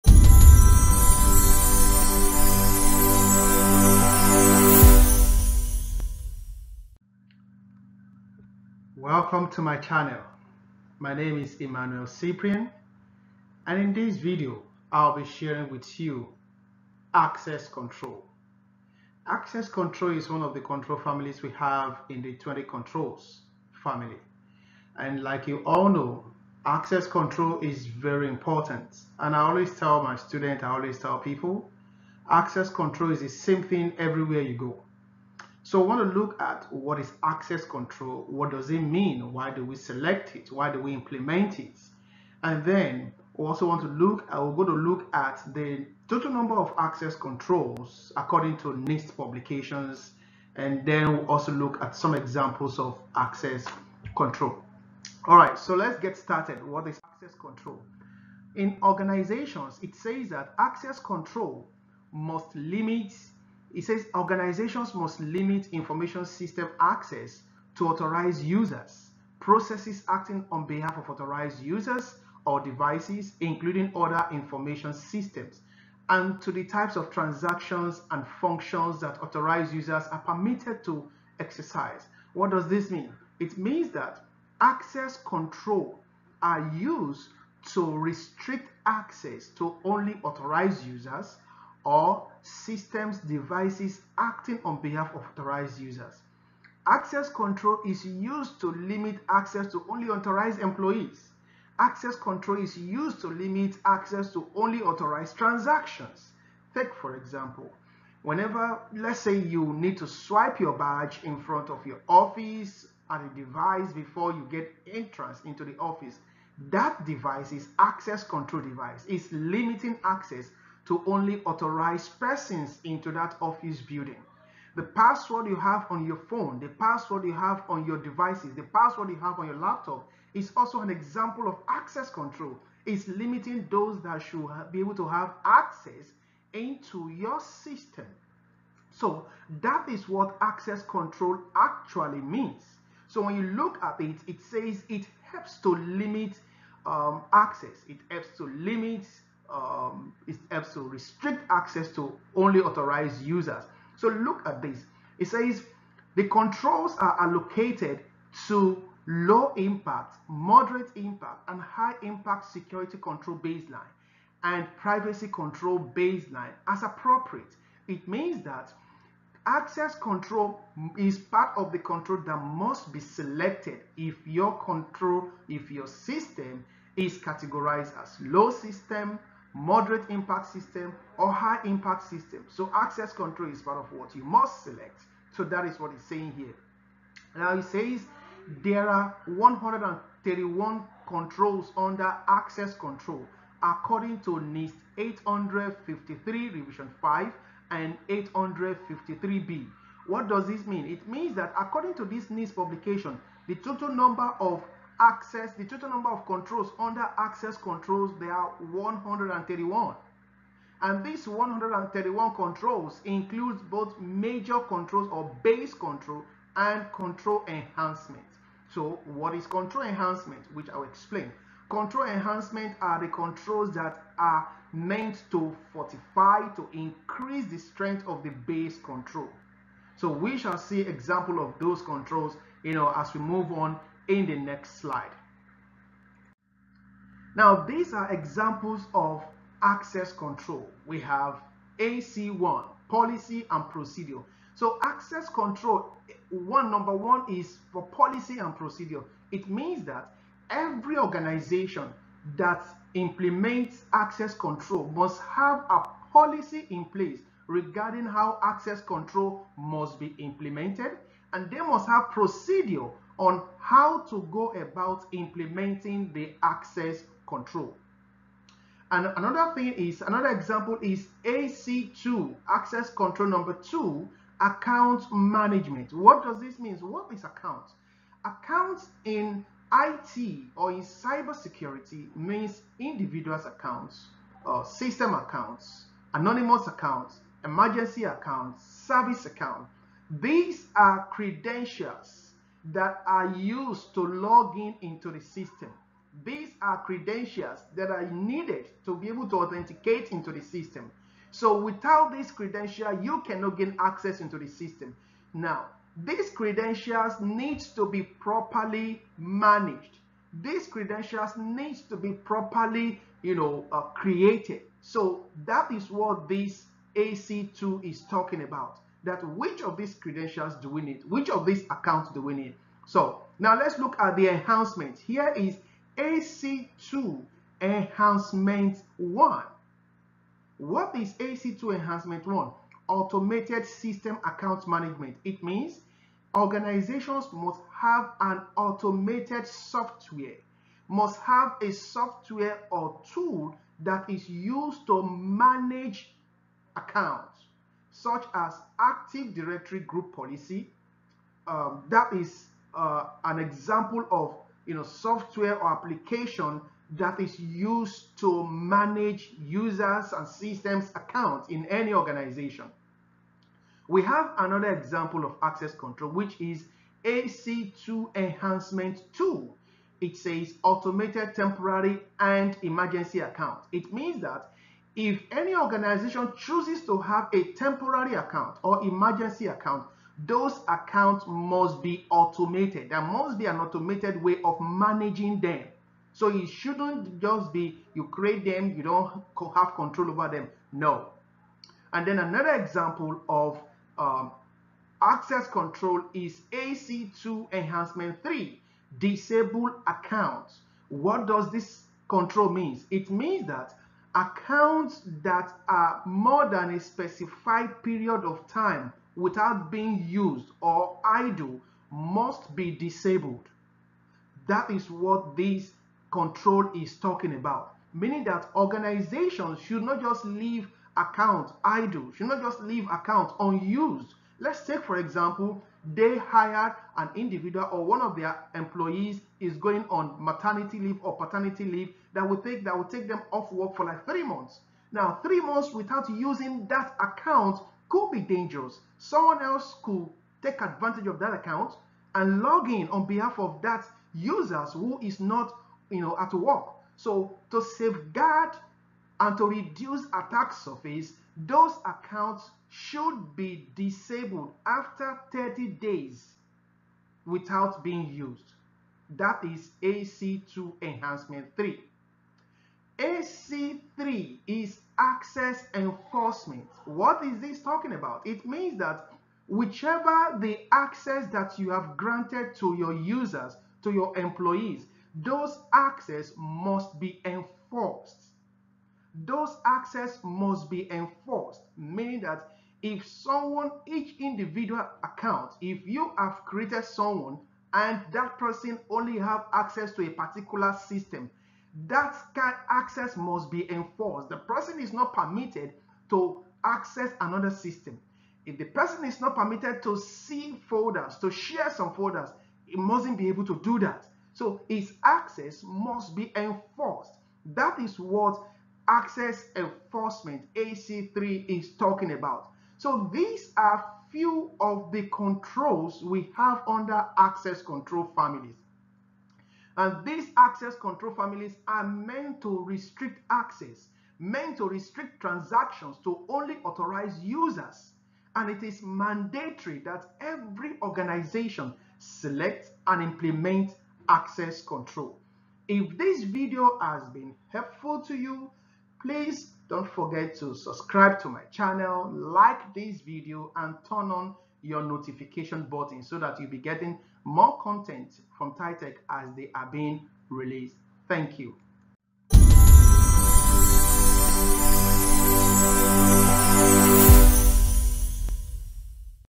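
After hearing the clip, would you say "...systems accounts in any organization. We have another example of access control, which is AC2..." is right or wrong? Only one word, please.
right.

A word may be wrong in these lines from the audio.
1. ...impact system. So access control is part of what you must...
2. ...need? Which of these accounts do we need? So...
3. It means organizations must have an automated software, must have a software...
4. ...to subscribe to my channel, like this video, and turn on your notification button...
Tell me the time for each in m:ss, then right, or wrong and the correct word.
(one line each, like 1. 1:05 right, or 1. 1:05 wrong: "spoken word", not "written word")
1. 3:01 right
2. 5:20 right
3. 5:35 right
4. 9:00 right.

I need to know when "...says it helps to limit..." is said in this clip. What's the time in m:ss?
2:24.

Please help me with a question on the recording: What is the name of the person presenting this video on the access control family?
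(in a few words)
Emmanuel Cyprian.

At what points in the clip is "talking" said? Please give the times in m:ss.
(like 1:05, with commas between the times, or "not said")
5:18, 6:56, 7:47, 8:31.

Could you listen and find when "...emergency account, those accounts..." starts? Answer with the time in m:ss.
6:18.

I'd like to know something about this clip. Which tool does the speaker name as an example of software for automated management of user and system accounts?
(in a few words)
Active Directory Group Policy.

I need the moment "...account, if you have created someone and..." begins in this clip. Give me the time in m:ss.
8:05.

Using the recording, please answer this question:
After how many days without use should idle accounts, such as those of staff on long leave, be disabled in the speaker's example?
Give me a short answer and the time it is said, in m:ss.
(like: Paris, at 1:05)
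30, at 7:35.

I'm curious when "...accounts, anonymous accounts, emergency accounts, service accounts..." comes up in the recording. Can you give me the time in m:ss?
4:45.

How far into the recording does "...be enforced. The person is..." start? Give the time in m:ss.
8:13.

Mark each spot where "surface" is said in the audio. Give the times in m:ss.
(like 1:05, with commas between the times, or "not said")
7:30.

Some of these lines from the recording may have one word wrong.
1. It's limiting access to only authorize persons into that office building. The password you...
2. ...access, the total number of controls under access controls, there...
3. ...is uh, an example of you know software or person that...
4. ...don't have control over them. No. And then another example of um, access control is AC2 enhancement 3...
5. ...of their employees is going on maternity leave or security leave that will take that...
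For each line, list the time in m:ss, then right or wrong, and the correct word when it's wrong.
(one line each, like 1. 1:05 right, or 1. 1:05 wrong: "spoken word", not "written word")
1. 1:59 right
2. 3:25 right
3. 5:52 wrong: "application", not "person"
4. 6:28 right
5. 7:08 wrong: "paternity", not "security".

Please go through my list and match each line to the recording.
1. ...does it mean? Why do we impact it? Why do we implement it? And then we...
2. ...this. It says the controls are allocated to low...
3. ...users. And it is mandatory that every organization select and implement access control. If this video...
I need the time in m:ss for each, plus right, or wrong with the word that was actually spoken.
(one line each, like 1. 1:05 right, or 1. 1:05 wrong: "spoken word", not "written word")
1. 0:38 wrong: "select", not "impact"
2. 2:34 right
3. 8:47 right.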